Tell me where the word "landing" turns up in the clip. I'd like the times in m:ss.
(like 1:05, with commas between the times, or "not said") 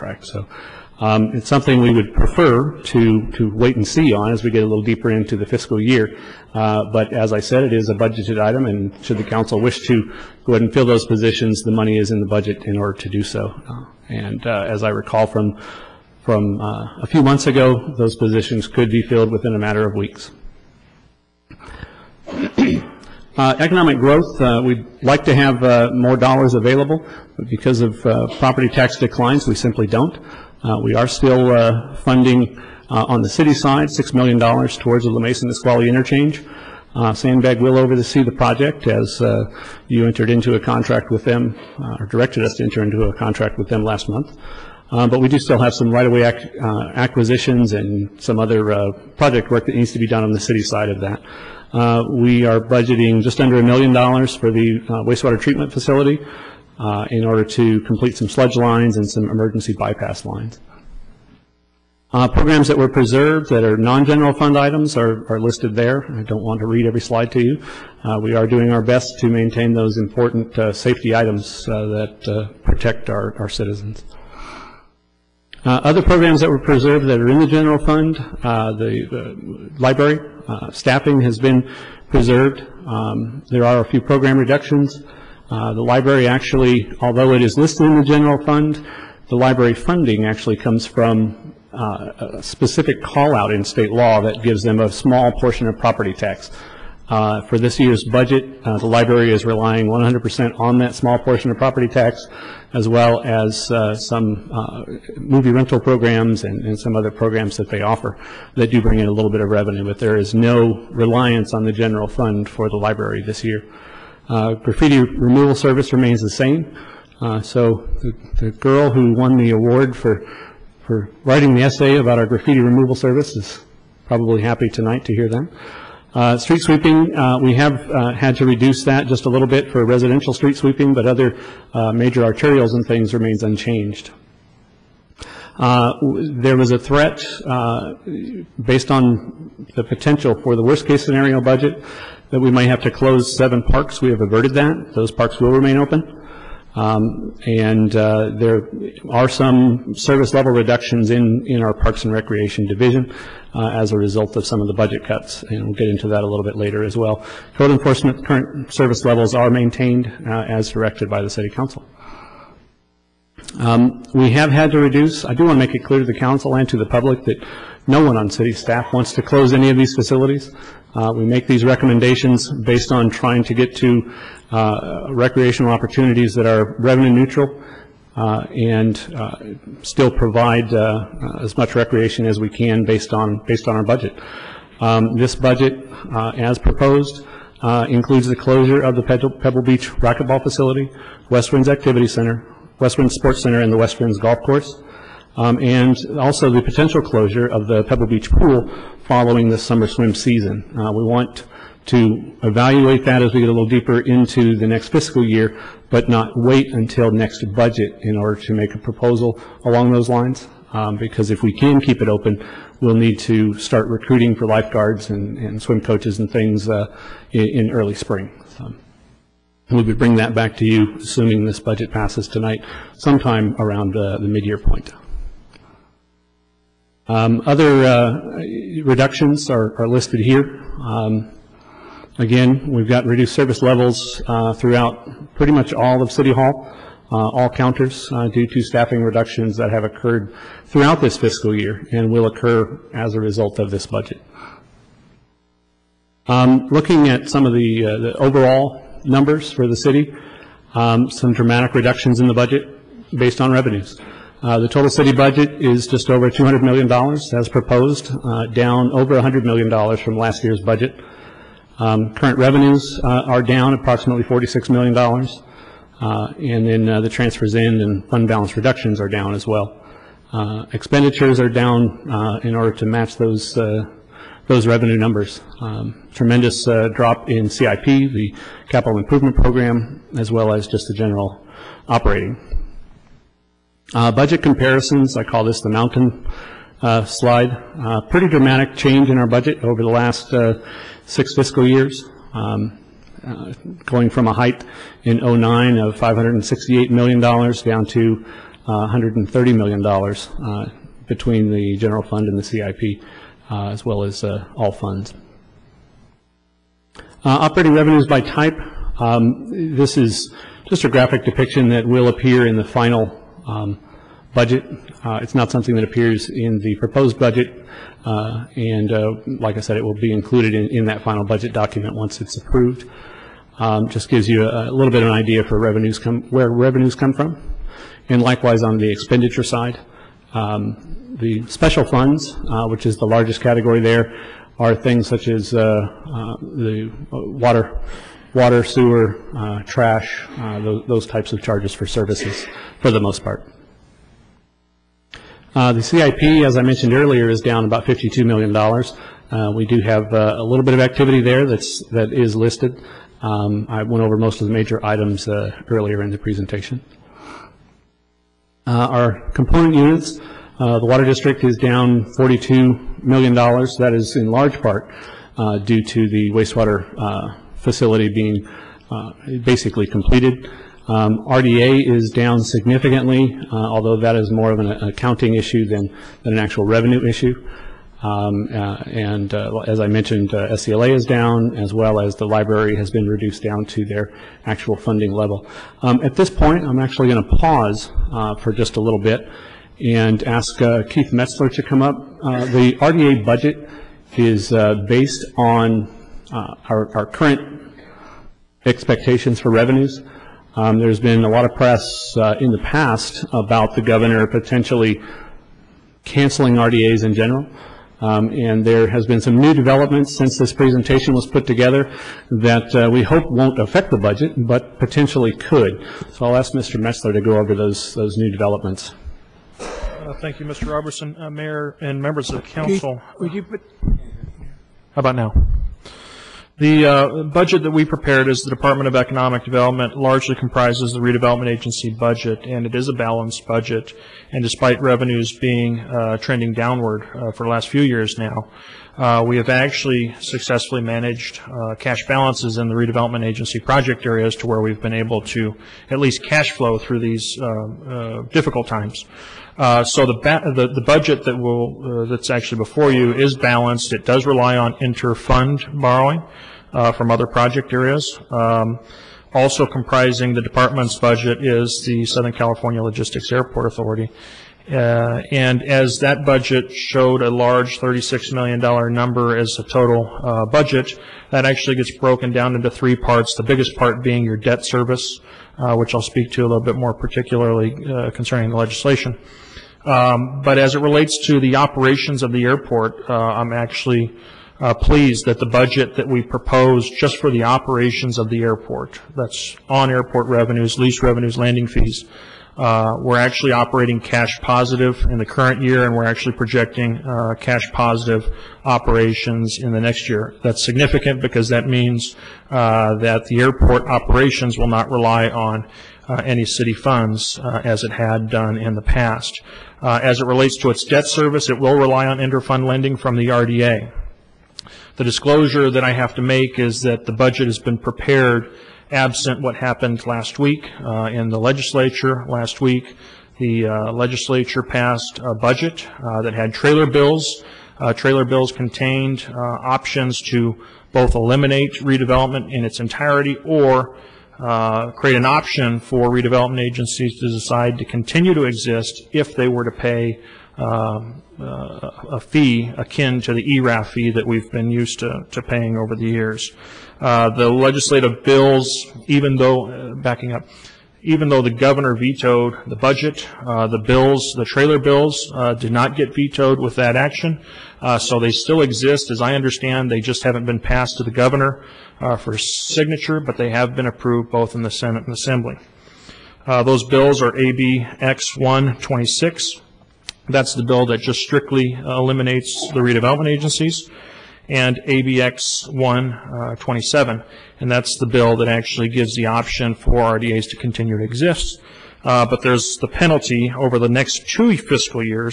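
8:11.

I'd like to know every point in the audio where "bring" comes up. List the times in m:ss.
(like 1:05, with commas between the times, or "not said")
1:48, 3:39.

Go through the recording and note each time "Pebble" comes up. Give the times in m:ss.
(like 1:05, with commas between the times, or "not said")
3:09, 3:17.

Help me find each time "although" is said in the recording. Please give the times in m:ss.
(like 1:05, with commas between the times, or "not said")
1:26, 6:13.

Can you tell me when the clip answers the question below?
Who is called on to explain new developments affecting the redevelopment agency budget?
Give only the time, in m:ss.
6:30.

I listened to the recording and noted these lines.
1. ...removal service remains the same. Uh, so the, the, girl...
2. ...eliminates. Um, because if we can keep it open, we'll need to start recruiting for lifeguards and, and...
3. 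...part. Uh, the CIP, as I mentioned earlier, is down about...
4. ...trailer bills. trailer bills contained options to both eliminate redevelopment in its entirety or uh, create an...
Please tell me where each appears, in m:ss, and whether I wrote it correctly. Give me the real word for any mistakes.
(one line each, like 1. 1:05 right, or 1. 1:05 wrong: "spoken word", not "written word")
1. 1:54 right
2. 3:30 wrong: "lines", not "eliminates"
3. 5:43 right
4. 8:46 right.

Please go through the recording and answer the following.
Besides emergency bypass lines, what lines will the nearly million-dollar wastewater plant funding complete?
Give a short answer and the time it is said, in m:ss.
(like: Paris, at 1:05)
Sludge lines, at 0:58.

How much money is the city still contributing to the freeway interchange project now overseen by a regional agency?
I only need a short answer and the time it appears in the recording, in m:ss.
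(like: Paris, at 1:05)
$6 million, at 0:33.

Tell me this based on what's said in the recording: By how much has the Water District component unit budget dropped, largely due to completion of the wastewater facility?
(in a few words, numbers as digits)
$42 million.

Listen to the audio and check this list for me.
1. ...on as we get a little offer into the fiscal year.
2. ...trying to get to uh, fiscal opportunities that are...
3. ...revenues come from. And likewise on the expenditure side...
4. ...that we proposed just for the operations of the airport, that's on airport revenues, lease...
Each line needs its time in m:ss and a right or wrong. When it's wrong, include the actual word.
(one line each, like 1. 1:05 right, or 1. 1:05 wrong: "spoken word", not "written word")
1. 0:04 wrong: "deeper", not "offer"
2. 2:53 wrong: "recreational", not "fiscal"
3. 5:26 right
4. 8:05 right.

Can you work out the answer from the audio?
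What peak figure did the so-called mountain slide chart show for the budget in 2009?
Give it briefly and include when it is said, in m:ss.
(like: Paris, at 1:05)
$568 million, at 4:55.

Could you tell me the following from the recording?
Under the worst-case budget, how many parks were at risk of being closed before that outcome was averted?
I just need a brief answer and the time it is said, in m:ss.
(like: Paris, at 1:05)
Seven, at 2:23.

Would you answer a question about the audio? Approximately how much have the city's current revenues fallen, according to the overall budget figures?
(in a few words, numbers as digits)
$46 million.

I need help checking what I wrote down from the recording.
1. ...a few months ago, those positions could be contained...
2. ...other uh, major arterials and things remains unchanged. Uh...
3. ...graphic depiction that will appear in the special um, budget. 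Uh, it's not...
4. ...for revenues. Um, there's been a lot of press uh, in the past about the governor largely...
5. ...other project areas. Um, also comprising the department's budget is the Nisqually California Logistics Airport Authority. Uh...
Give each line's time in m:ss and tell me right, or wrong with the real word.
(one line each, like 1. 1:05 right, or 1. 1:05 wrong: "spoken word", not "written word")
1. 0:17 wrong: "filled", not "contained"
2. 2:11 right
3. 5:10 wrong: "final", not "special"
4. 6:39 wrong: "potentially", not "largely"
5. 7:37 wrong: "Southern", not "Nisqually".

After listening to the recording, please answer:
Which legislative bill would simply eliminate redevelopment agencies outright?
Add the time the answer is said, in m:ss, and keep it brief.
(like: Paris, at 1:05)
ABX 126, at 9:27.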